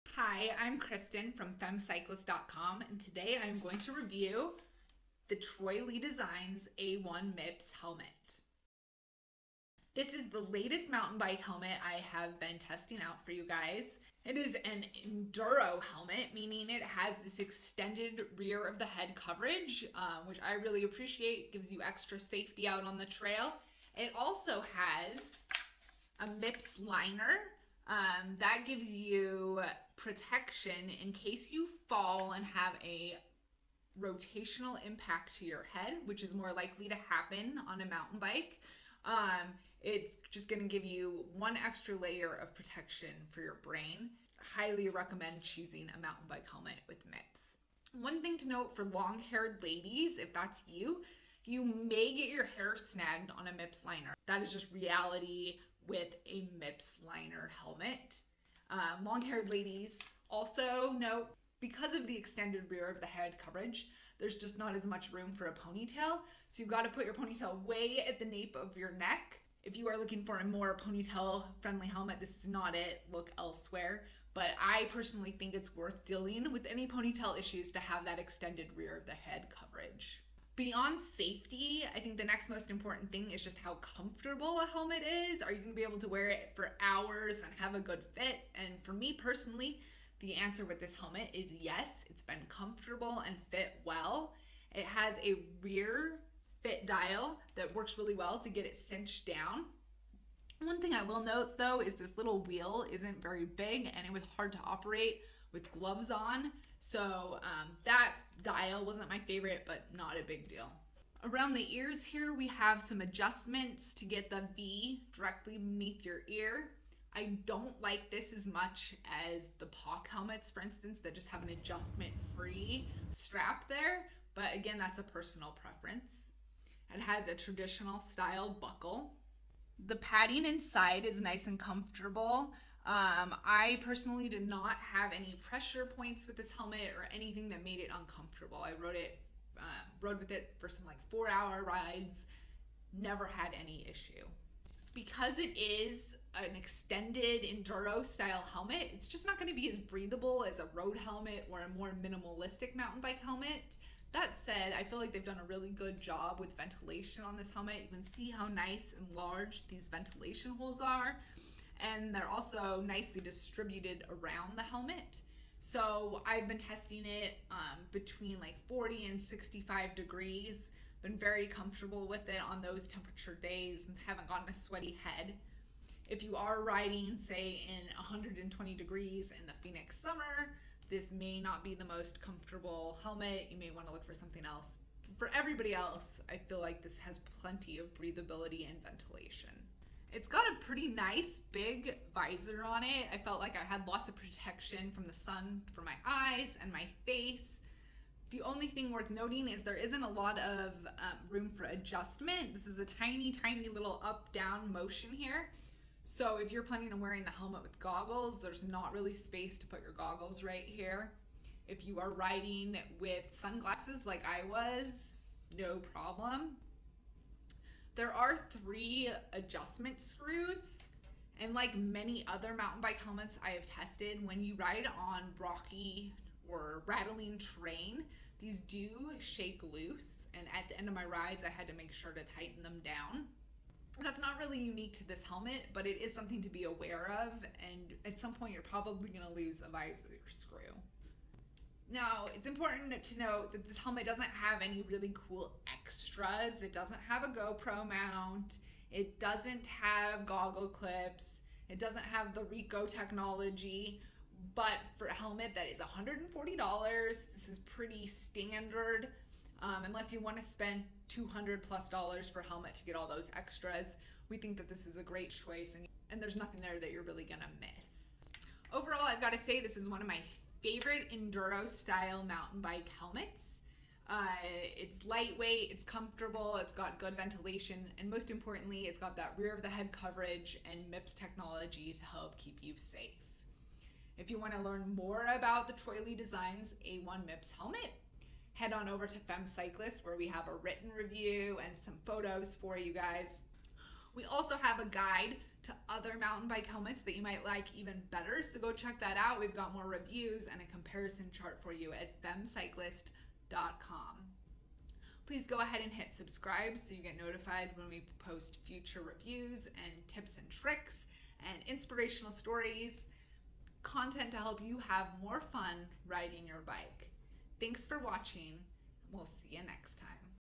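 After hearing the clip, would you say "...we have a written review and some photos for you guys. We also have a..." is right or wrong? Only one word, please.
right.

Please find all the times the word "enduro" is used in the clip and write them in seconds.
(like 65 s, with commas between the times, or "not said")
15 s, 147 s, 271 s.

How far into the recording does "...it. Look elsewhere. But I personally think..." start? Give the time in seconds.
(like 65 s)
72 s.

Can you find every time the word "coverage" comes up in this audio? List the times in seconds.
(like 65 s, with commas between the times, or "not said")
19 s, 63 s, 79 s, 279 s.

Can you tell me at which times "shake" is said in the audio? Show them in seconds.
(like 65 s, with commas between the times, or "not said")
229 s.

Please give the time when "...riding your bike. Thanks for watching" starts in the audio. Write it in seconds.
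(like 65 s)
316 s.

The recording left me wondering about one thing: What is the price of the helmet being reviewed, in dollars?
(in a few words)
$140.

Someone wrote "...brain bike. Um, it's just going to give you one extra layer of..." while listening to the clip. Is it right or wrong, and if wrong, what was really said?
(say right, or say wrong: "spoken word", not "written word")
wrong: "mountain", not "brain".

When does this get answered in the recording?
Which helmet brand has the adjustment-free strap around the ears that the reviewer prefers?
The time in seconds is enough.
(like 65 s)
119 s.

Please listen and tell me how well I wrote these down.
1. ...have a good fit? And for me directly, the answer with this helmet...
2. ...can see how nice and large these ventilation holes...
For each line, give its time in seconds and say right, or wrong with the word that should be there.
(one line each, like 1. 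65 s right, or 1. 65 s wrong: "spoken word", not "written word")
1. 87 s wrong: "personally", not "directly"
2. 157 s right.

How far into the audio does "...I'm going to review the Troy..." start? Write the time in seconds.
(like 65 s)
3 s.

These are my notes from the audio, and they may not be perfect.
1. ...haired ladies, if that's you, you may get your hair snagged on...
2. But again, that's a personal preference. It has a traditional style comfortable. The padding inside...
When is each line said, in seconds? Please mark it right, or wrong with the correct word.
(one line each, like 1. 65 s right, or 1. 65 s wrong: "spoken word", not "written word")
1. 49 s right
2. 124 s wrong: "buckle", not "comfortable".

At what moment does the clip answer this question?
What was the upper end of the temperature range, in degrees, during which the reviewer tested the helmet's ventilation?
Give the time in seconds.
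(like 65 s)
169 s.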